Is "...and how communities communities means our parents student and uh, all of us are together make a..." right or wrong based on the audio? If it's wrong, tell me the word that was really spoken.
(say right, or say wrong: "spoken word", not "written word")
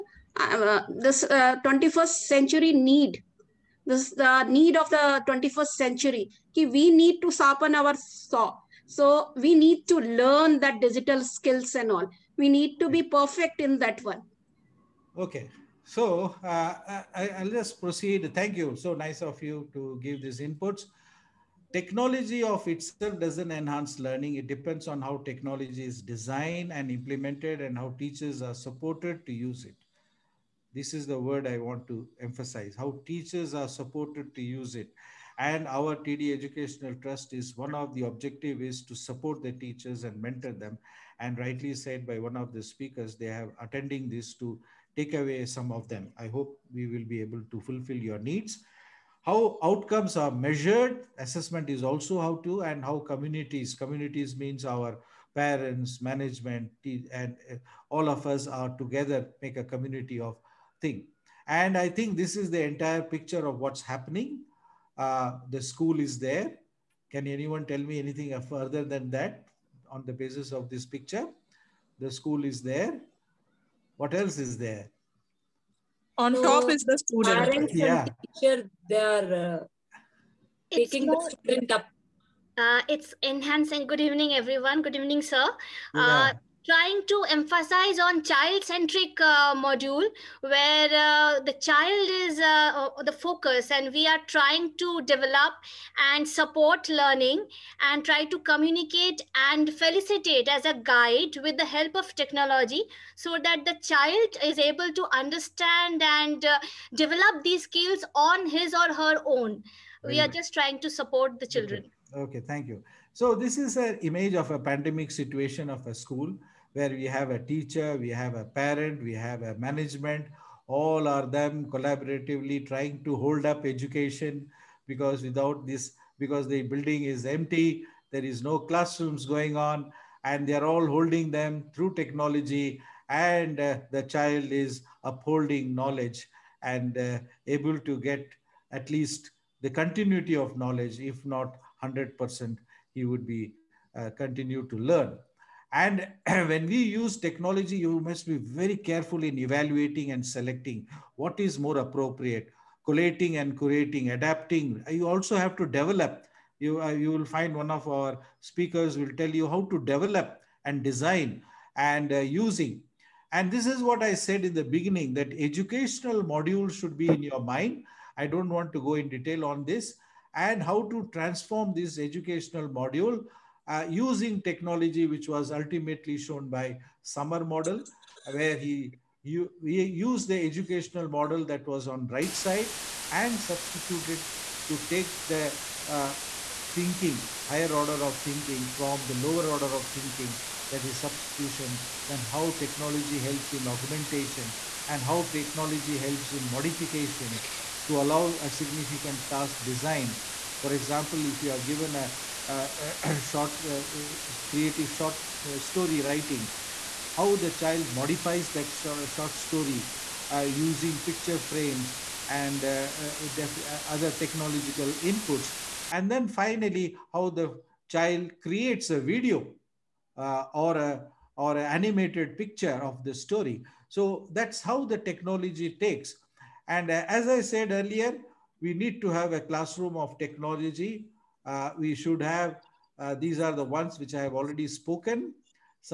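wrong: "management", not "student".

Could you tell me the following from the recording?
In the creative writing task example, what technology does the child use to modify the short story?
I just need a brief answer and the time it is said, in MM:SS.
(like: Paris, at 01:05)
picture frames, at 03:31.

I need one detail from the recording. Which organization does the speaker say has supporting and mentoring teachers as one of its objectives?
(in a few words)
TD Educational Trust.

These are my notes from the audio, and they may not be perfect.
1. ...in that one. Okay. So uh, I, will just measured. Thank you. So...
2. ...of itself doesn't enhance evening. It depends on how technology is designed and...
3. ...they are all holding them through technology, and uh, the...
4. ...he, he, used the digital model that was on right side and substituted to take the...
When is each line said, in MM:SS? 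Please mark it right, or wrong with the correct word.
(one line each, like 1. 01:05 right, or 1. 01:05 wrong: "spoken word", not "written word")
1. 00:13 wrong: "proceed", not "measured"
2. 00:22 wrong: "learning", not "evening"
3. 02:10 right
4. 02:58 wrong: "educational", not "digital".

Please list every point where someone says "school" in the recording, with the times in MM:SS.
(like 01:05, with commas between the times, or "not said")
01:05, 01:12, 01:55.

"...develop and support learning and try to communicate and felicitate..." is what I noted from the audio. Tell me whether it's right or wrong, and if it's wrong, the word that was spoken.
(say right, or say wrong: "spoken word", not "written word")
right.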